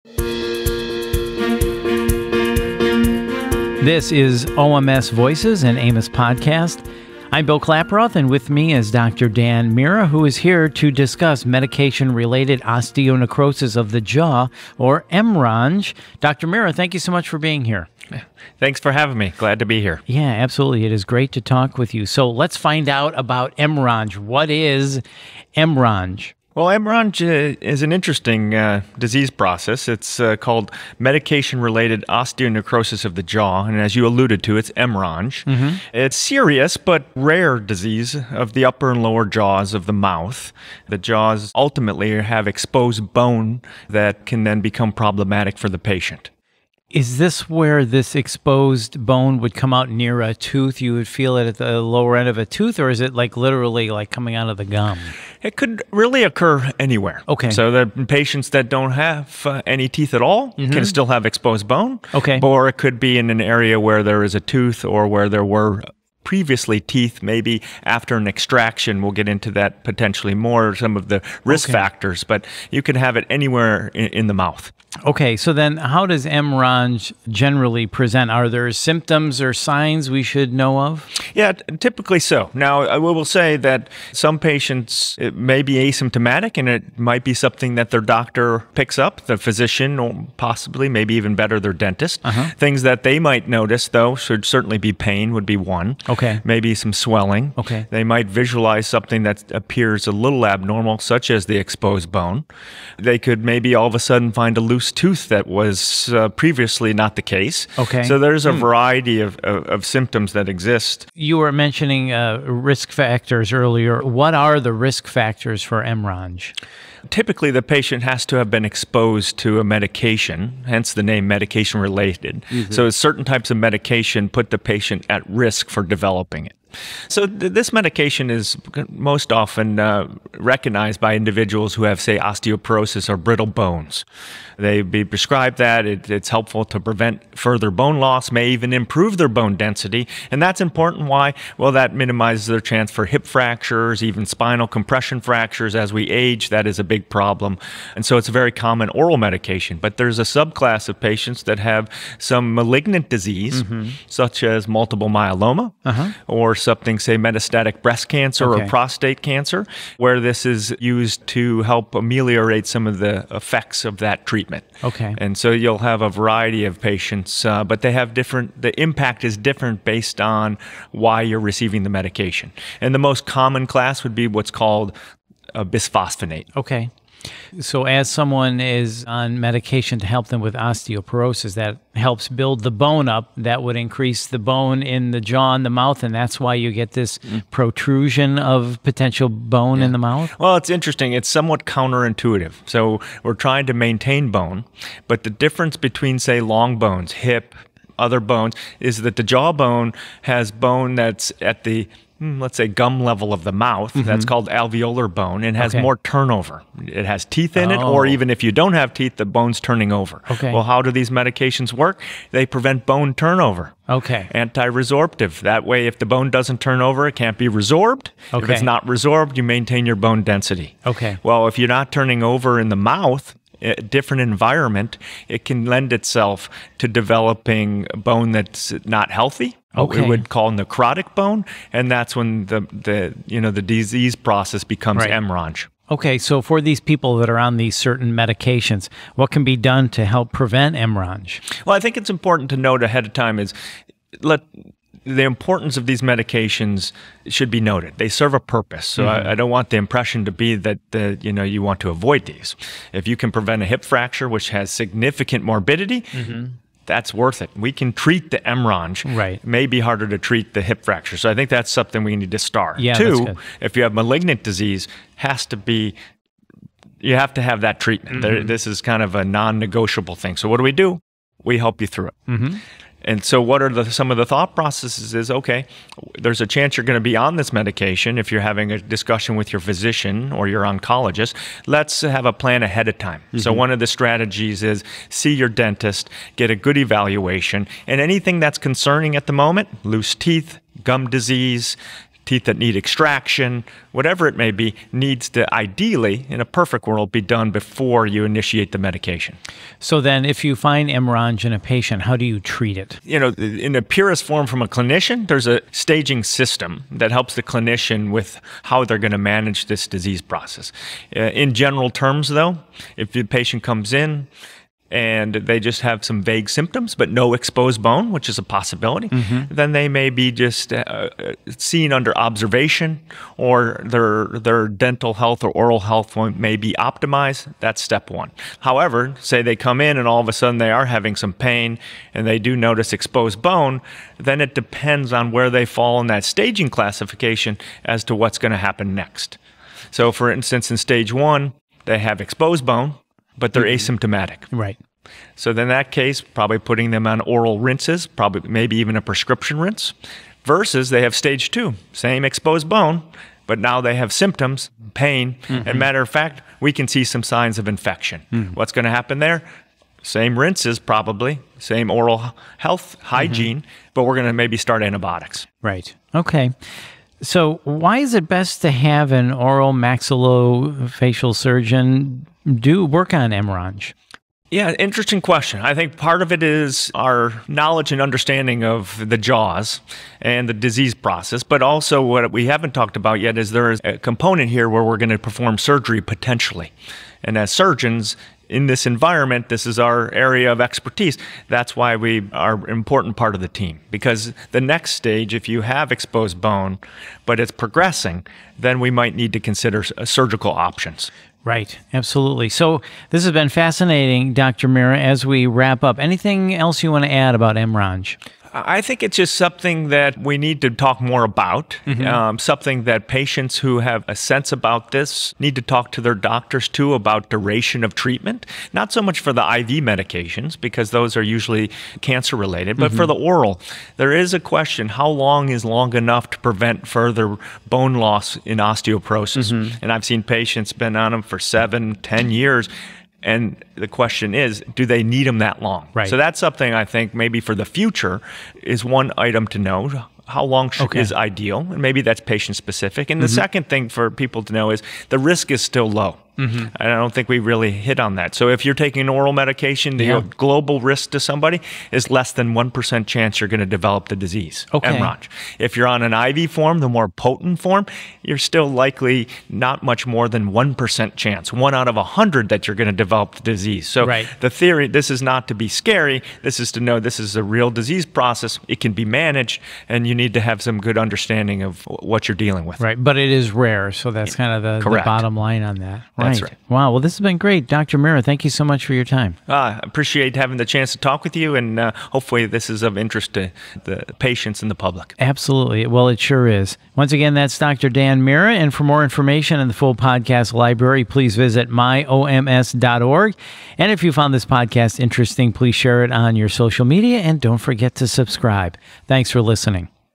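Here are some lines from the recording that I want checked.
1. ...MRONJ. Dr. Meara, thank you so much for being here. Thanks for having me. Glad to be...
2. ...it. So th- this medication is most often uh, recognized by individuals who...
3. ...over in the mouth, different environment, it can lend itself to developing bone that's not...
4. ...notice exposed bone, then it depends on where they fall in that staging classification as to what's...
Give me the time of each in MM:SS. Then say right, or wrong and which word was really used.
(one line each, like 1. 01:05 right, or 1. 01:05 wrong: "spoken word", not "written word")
1. 00:15 right
2. 02:06 right
3. 03:42 right
4. 05:32 right.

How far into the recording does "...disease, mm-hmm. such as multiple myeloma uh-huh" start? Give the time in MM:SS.
02:33.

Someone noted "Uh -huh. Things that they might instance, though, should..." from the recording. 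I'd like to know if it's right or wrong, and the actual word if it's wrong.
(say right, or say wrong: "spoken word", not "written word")
wrong: "notice", not "instance".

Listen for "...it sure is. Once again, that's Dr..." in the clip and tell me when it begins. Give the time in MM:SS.
08:06.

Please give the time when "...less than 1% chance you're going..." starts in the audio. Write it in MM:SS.
07:32.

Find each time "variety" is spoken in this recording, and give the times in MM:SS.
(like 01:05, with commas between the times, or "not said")
01:48, 02:46.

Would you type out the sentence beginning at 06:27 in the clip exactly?
And as surgeons, in this environment, this is our area of expertise.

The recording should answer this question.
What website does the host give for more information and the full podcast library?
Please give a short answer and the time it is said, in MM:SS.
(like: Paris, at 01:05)
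myoms.org, at 08:11.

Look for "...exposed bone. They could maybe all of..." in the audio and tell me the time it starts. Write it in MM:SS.
01:41.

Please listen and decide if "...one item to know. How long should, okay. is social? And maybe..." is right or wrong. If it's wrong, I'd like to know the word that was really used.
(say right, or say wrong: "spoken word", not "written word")
wrong: "ideal", not "social".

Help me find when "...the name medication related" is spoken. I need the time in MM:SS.
02:00.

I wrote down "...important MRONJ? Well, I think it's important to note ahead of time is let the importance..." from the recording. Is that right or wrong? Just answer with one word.
wrong.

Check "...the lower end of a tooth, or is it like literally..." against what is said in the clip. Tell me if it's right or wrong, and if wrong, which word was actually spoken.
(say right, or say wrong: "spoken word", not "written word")
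right.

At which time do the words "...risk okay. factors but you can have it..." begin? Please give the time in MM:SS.
01:11.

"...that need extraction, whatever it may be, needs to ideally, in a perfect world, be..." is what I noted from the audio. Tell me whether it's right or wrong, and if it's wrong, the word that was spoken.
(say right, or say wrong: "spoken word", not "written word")
right.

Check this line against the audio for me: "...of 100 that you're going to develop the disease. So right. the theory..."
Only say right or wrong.
right.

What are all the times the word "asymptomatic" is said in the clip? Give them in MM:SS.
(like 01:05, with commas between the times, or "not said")
01:25, 05:43.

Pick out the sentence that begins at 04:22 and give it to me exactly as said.
Yeah, Two, if you have malignant disease, has to be you have to have that treatment.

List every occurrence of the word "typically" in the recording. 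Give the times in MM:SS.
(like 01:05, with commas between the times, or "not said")
01:21, 01:57.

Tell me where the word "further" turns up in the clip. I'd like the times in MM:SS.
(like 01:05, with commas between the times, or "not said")
02:17, 07:06.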